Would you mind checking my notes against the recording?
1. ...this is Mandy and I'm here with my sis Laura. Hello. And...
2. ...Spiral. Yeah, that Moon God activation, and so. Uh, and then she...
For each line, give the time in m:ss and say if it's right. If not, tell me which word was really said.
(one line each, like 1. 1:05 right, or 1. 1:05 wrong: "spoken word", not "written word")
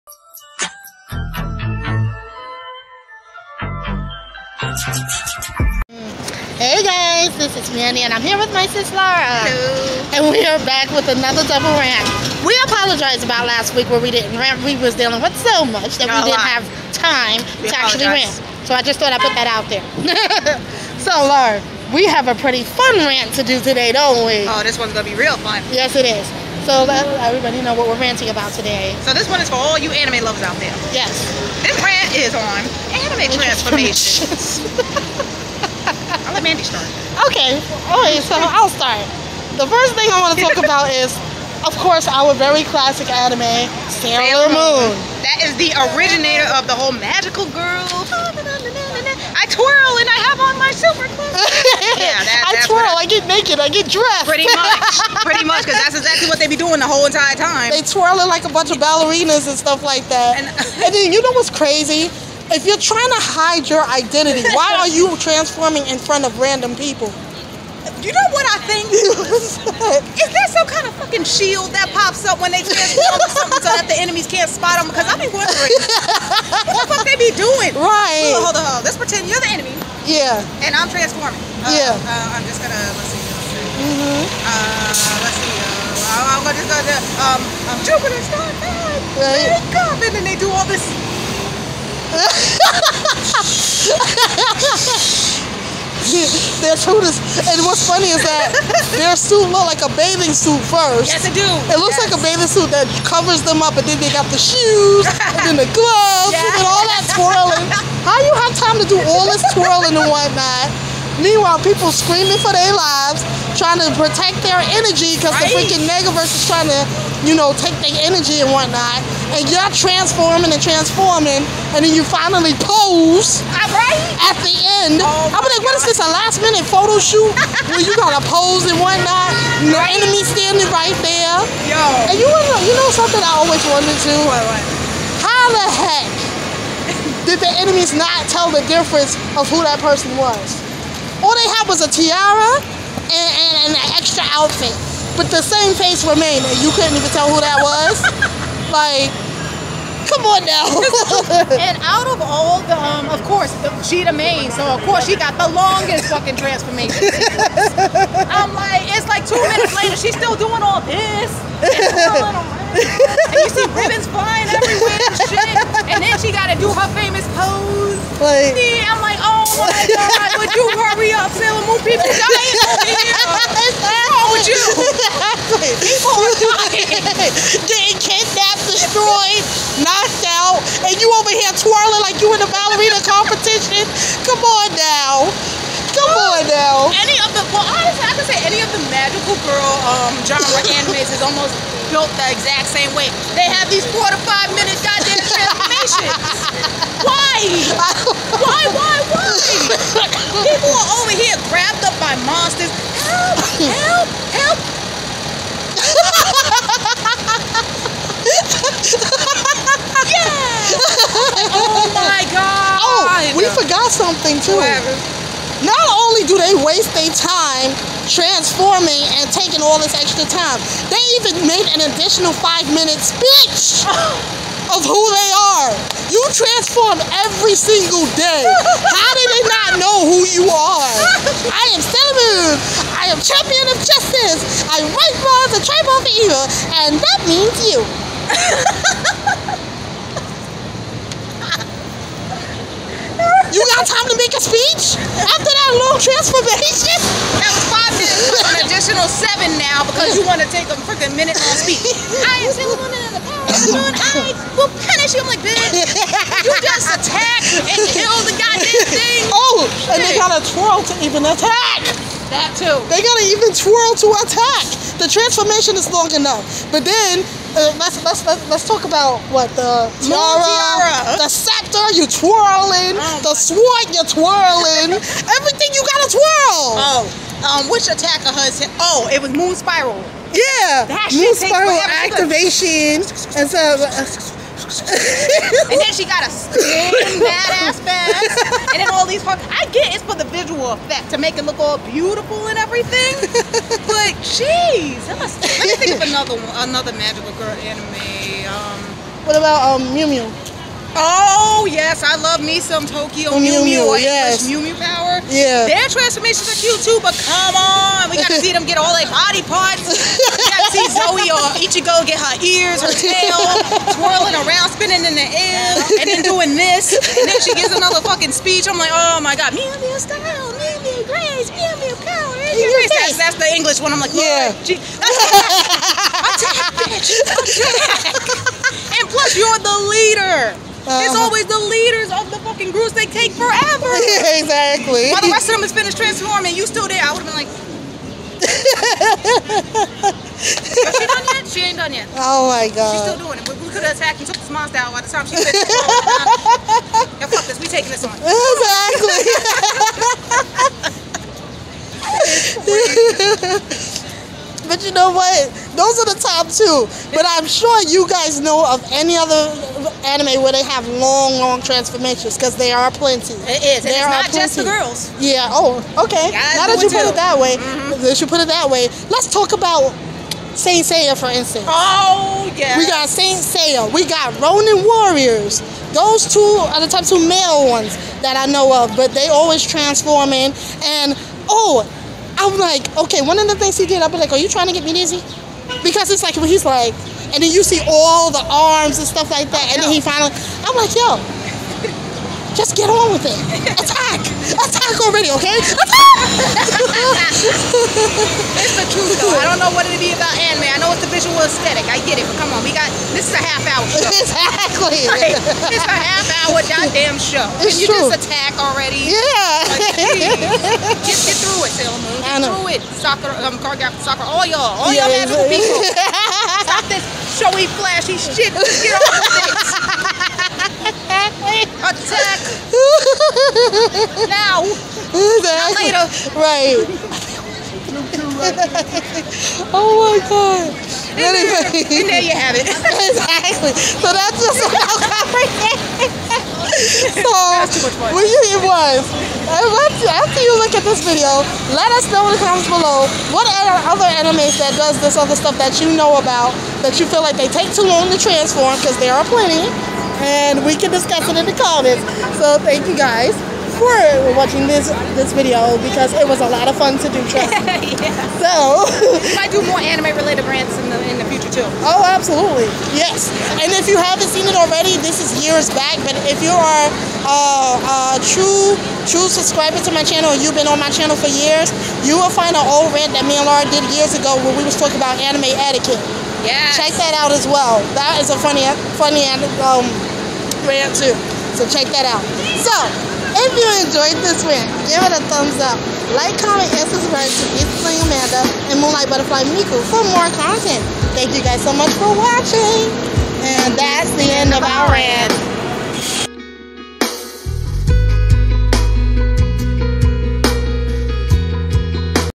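1. 0:07 right
2. 4:39 wrong: "Spiral", not "God".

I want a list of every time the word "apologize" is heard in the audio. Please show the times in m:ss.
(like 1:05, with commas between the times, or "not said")
0:12, 0:17.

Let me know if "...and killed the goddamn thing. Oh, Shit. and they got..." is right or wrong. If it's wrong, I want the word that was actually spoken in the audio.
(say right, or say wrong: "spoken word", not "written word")
right.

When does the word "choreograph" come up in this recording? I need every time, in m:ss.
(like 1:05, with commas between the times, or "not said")
6:53.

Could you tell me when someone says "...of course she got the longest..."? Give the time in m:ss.
2:34.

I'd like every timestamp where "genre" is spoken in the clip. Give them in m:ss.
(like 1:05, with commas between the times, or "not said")
3:10.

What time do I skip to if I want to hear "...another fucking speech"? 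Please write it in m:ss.
5:17.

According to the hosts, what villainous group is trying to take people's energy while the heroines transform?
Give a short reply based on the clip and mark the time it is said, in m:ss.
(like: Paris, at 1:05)
Negaverse, at 1:55.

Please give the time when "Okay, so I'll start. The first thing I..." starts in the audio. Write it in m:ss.
0:37.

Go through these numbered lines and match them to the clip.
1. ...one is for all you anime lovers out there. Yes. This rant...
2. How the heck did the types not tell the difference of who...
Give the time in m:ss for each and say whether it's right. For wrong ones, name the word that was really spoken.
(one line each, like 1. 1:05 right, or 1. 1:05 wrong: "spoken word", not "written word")
1. 0:29 right
2. 2:15 wrong: "enemies", not "types".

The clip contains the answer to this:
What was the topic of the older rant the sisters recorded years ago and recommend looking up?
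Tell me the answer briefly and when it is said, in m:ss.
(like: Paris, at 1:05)
Anime etiquette, at 7:55.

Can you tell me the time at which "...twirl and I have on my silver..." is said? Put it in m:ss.
0:49.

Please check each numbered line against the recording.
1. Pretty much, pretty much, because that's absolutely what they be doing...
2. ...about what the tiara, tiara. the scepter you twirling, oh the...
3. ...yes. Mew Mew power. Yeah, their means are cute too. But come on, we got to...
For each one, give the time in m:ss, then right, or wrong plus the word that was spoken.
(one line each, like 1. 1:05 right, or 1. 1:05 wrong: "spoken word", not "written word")
1. 0:54 wrong: "exactly", not "absolutely"
2. 4:28 right
3. 5:03 wrong: "transformations", not "means".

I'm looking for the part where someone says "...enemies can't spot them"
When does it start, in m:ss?
1:13.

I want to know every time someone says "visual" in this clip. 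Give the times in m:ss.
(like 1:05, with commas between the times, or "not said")
4:50, 6:41.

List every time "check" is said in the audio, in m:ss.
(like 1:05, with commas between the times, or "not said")
7:56, 8:01.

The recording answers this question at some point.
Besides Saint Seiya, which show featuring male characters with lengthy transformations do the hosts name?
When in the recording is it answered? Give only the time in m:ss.
6:14.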